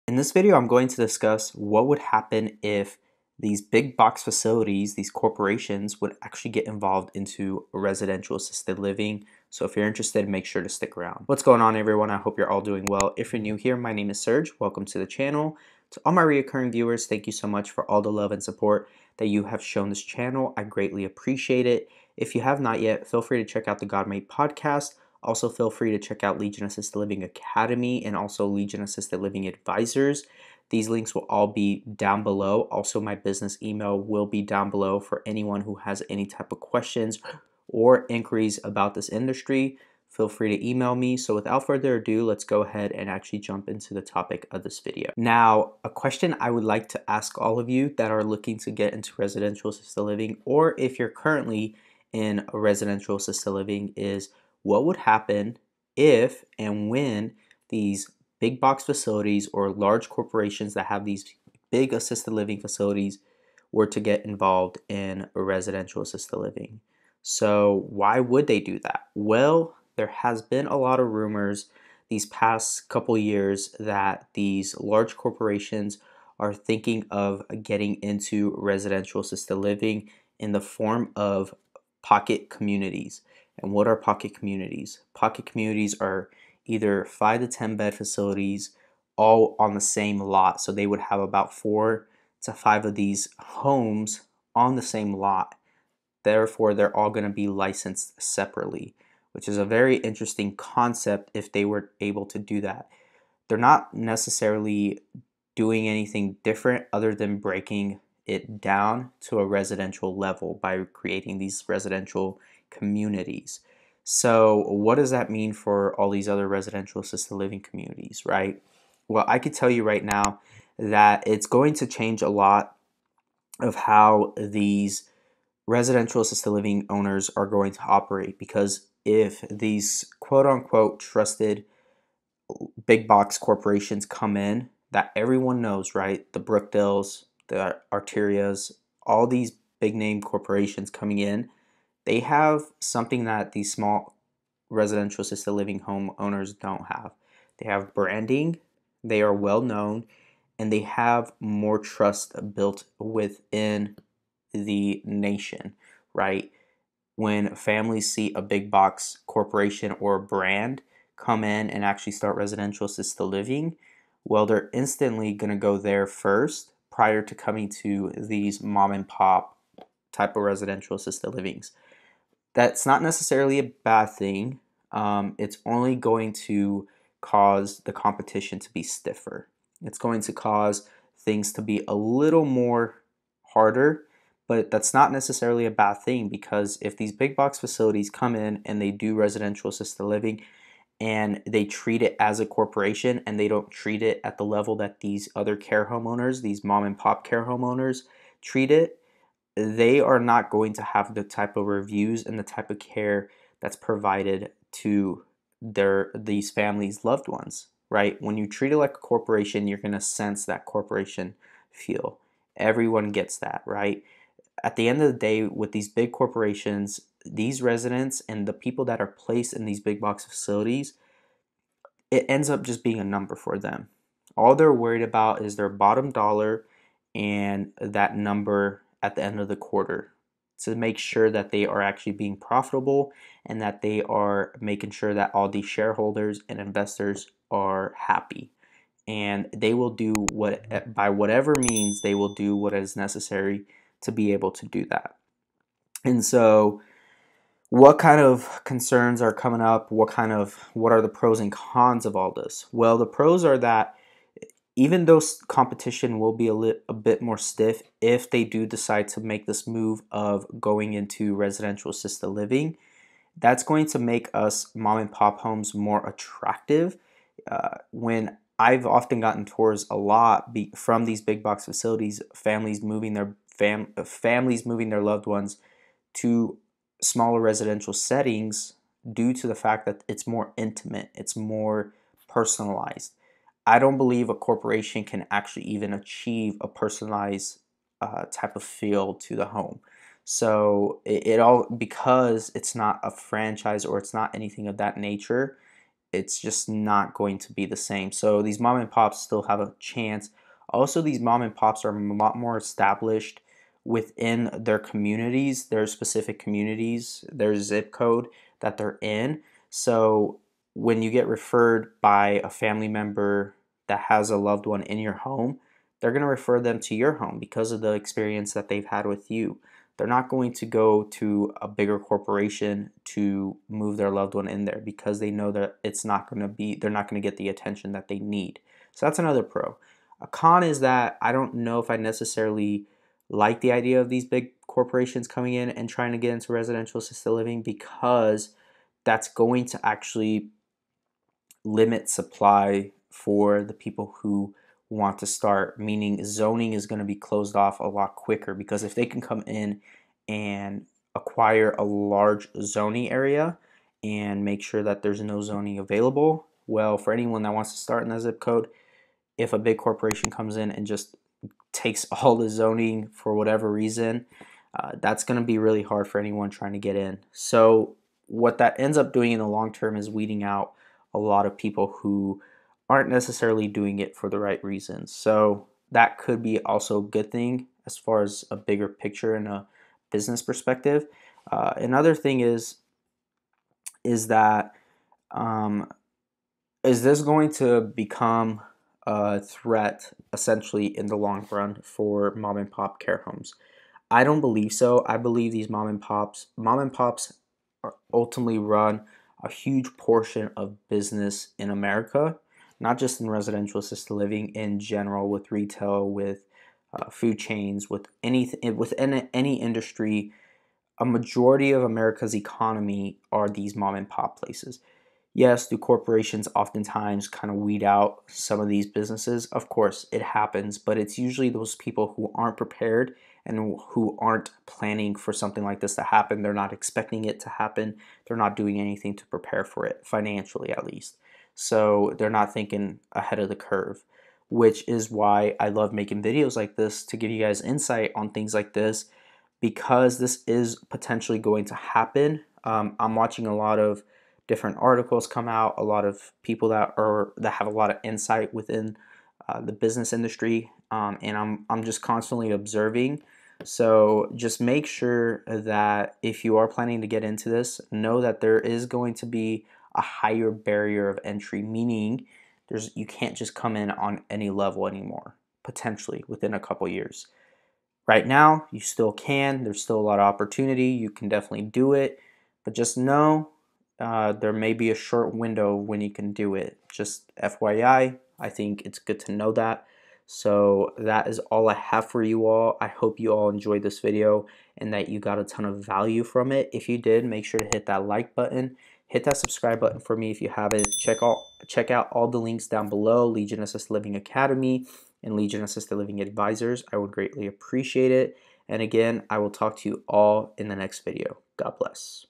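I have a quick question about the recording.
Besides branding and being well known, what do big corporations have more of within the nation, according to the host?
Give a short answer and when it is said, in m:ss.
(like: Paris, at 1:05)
Trust, at 2:31.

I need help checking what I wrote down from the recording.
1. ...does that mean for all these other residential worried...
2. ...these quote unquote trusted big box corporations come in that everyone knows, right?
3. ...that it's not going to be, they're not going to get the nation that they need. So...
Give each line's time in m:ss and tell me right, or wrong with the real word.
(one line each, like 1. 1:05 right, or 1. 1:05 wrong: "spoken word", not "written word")
1. 1:54 wrong: "assisted", not "worried"
2. 2:09 right
3. 5:25 wrong: "attention", not "nation".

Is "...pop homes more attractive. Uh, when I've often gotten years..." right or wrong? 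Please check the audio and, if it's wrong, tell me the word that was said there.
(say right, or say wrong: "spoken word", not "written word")
wrong: "tours", not "years".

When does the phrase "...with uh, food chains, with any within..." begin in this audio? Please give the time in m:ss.
6:46.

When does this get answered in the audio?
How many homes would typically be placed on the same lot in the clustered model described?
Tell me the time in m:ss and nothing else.
1:31.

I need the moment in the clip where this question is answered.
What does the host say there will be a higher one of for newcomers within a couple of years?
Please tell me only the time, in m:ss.
7:40.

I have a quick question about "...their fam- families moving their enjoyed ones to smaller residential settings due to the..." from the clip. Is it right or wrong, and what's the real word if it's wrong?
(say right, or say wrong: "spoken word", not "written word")
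wrong: "loved", not "enjoyed".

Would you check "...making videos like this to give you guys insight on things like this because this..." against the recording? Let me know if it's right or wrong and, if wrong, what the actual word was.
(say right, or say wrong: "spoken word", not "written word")
right.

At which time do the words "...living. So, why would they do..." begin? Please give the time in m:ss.
1:06.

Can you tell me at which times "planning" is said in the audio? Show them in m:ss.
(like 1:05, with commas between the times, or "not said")
7:04, 7:36.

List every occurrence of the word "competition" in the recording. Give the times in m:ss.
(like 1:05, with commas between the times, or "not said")
2:57, 4:15.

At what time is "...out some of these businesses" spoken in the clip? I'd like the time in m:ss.
6:57.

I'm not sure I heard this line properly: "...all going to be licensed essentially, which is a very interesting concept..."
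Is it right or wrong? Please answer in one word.
wrong.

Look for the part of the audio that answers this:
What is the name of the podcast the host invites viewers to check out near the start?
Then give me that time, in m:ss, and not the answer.
0:23.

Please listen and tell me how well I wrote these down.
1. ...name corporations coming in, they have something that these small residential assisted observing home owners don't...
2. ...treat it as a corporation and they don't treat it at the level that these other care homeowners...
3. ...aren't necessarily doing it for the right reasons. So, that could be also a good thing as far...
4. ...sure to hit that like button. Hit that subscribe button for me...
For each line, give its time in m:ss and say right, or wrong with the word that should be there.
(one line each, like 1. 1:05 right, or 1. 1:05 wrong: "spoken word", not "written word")
1. 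2:19 wrong: "living", not "observing"
2. 3:11 right
3. 6:12 right
4. 8:07 right.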